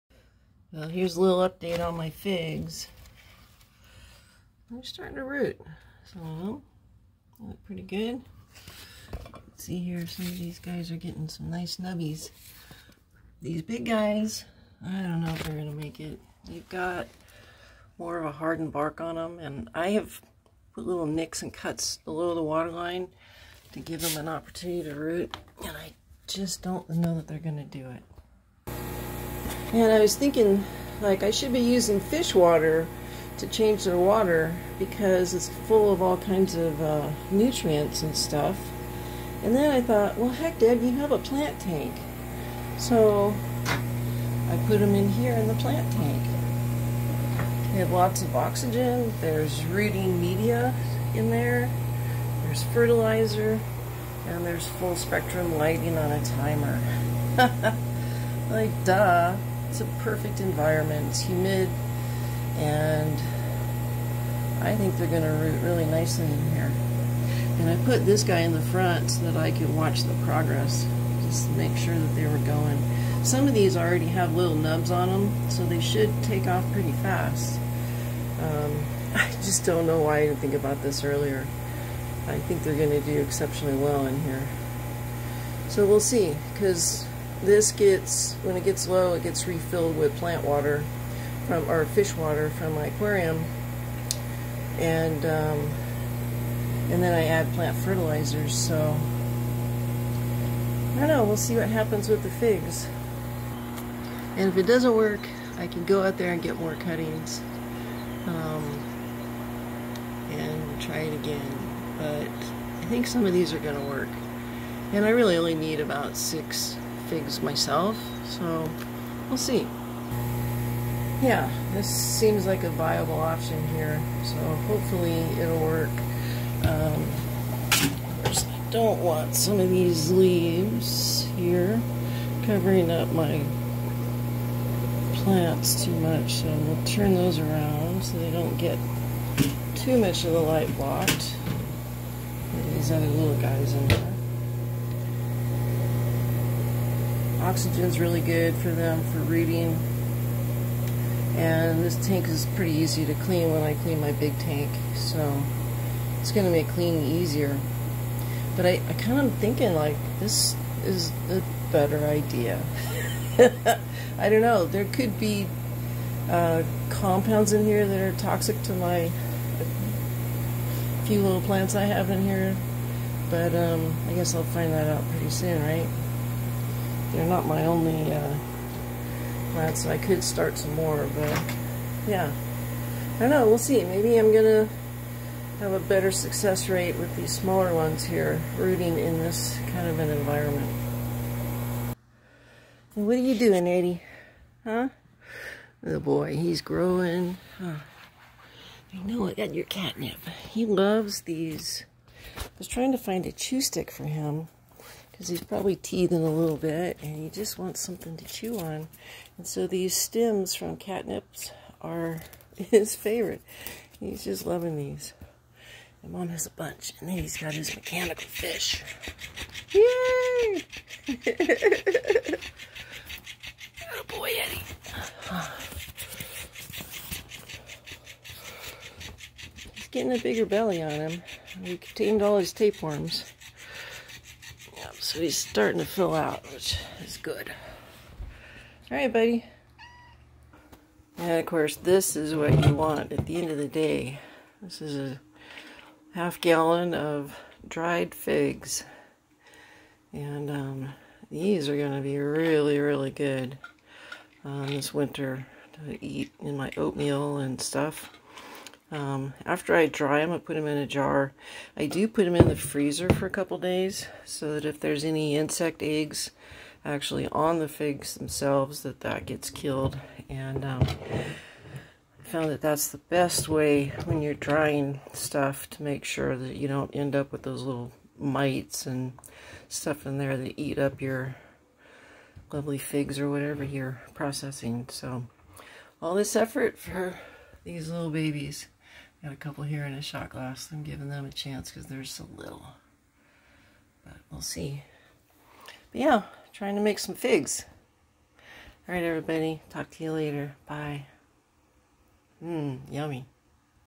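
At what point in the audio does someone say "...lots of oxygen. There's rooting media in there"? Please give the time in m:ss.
0:47.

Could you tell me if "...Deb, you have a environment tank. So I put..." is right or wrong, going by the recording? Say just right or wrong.
wrong.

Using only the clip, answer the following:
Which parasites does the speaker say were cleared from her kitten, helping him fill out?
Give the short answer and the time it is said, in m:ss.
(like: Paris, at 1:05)
Tapeworms, at 3:52.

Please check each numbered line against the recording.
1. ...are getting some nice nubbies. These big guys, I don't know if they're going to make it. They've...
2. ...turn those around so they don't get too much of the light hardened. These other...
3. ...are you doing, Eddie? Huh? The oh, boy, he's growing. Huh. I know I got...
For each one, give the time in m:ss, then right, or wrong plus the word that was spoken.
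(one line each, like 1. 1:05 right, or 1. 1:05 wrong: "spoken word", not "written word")
1. 0:10 right
2. 2:16 wrong: "blocked", not "hardened"
3. 3:13 right.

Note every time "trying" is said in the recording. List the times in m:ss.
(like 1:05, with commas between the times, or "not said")
3:22, 4:56.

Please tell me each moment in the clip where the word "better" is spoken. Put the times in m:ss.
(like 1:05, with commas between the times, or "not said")
2:41, 3:05.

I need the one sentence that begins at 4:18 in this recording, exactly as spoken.
Um, after I dry them, I put them in a jar.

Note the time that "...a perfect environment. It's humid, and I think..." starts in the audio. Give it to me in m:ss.
0:59.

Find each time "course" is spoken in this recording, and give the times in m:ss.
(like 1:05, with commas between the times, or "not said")
2:08, 4:01.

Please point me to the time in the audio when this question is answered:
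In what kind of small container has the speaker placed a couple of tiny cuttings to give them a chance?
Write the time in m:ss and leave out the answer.
4:50.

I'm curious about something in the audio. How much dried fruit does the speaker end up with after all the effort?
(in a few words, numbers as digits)
Half gallon.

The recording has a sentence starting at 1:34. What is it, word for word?
And, um, and then I add plant fertilizers, so I don't know, we'll see what happens with the figs.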